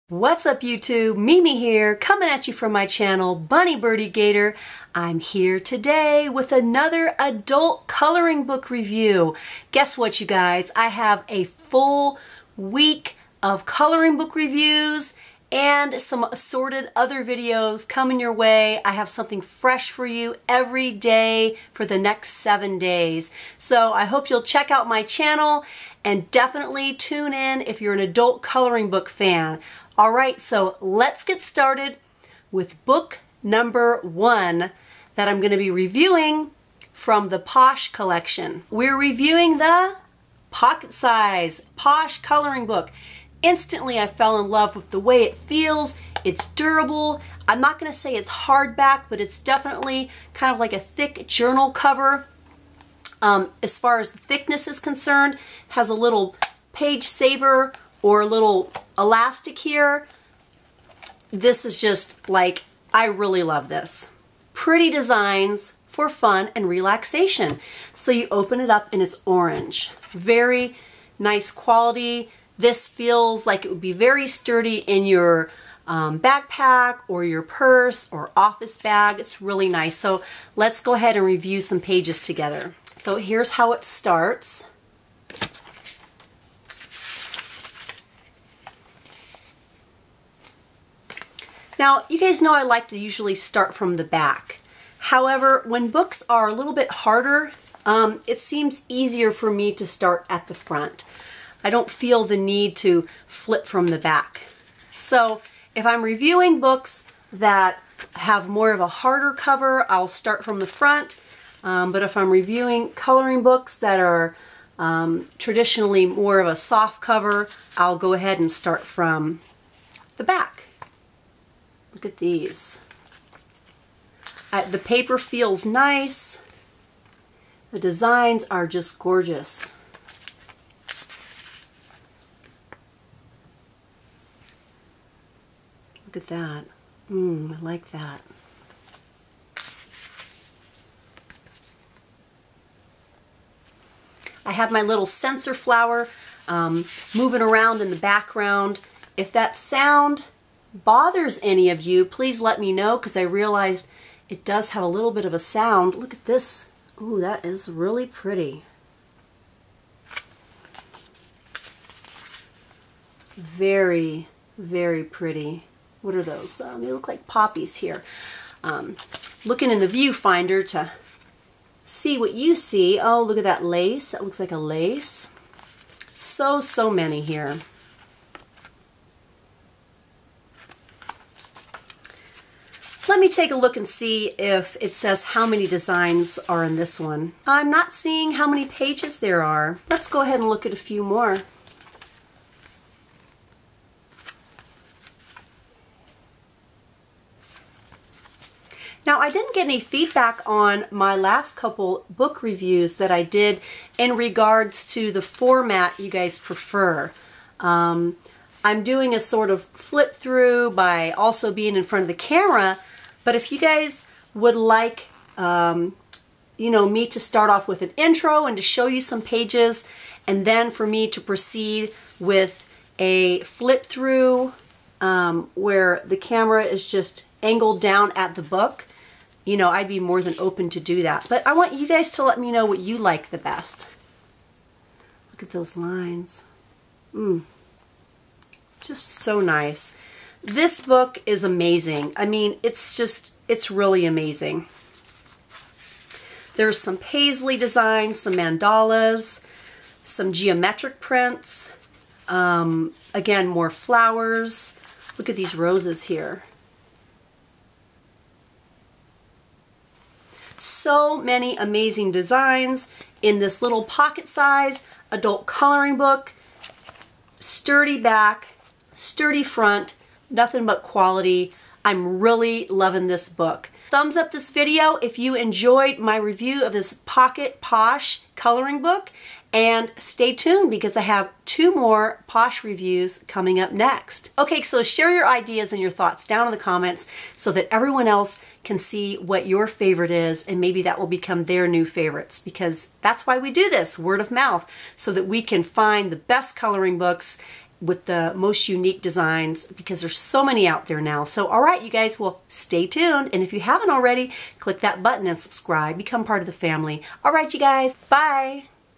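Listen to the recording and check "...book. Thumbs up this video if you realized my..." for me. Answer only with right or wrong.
wrong.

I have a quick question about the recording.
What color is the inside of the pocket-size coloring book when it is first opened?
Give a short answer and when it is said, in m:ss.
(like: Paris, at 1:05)
Orange, at 1:09.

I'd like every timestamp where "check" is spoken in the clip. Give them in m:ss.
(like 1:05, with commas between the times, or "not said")
0:24.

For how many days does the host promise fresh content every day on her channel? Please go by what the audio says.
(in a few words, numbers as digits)
7.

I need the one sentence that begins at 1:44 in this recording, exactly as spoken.
So if I'm reviewing books that have more of a harder cover, I'll start from the front.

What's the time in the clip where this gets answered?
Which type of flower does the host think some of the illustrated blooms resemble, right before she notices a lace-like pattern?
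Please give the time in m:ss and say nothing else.
2:47.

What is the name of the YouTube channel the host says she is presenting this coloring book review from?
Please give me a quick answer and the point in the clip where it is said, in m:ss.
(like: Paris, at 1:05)
Bunny Birdy Gator, at 0:03.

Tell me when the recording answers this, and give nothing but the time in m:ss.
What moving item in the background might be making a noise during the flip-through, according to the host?
2:25.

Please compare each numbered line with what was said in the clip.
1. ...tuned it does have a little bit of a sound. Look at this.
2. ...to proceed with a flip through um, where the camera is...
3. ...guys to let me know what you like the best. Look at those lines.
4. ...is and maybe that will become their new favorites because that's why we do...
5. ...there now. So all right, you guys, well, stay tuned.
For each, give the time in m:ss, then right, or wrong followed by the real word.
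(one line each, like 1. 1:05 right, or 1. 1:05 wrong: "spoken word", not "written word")
1. 2:33 wrong: "realized", not "tuned"
2. 3:41 right
3. 3:51 right
4. 4:50 right
5. 5:00 right.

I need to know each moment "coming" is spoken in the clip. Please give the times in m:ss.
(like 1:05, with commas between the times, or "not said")
0:01, 0:17, 4:43.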